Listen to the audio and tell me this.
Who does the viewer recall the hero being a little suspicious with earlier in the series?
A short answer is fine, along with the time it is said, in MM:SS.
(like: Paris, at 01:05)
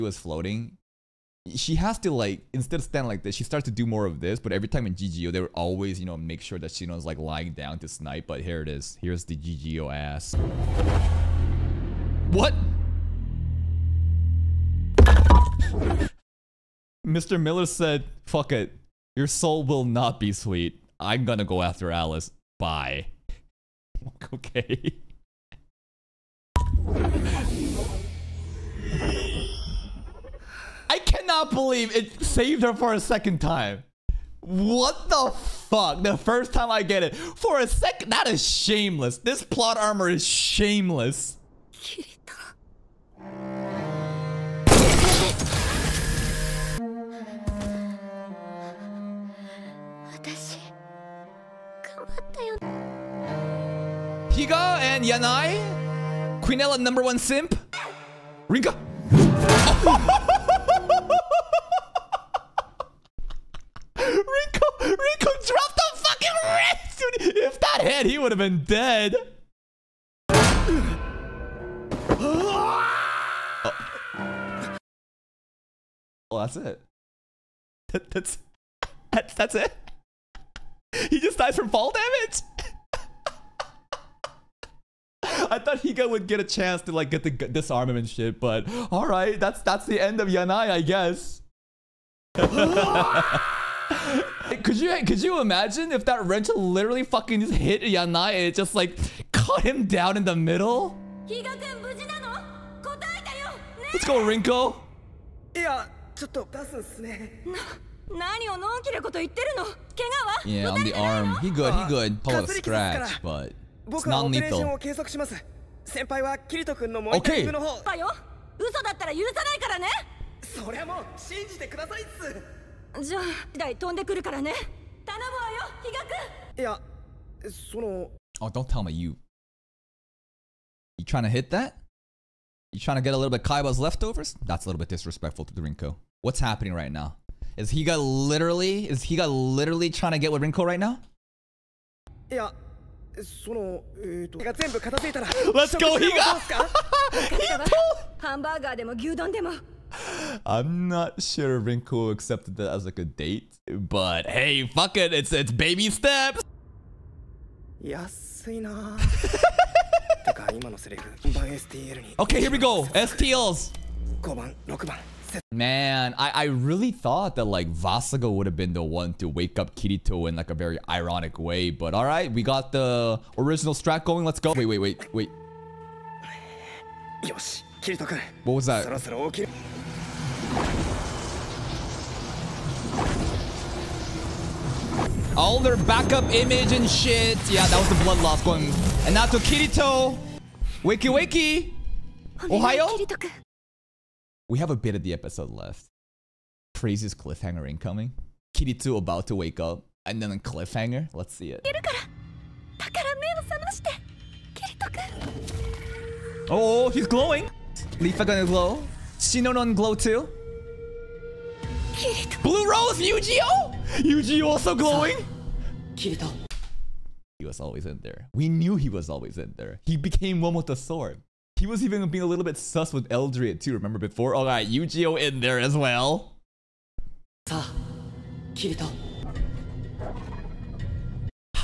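Eldrie, at 03:43.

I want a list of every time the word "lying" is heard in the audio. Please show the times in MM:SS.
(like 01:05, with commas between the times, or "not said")
00:07.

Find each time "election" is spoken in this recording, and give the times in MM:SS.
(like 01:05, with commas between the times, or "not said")
not said.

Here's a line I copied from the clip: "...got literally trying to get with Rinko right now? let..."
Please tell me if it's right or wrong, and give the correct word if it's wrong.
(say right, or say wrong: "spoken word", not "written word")
right.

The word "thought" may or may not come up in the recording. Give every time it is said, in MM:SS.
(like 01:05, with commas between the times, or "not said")
01:25, 02:46.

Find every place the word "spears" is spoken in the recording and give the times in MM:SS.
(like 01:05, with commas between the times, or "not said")
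not said.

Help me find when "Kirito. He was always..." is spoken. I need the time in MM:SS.
03:35.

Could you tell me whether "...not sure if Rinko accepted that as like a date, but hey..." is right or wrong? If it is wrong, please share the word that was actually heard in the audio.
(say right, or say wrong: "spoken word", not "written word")
right.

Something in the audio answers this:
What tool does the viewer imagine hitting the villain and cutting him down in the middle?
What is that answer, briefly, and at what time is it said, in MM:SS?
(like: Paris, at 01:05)
Wrench, at 01:36.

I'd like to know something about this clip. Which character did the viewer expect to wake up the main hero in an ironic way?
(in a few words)
Vasago.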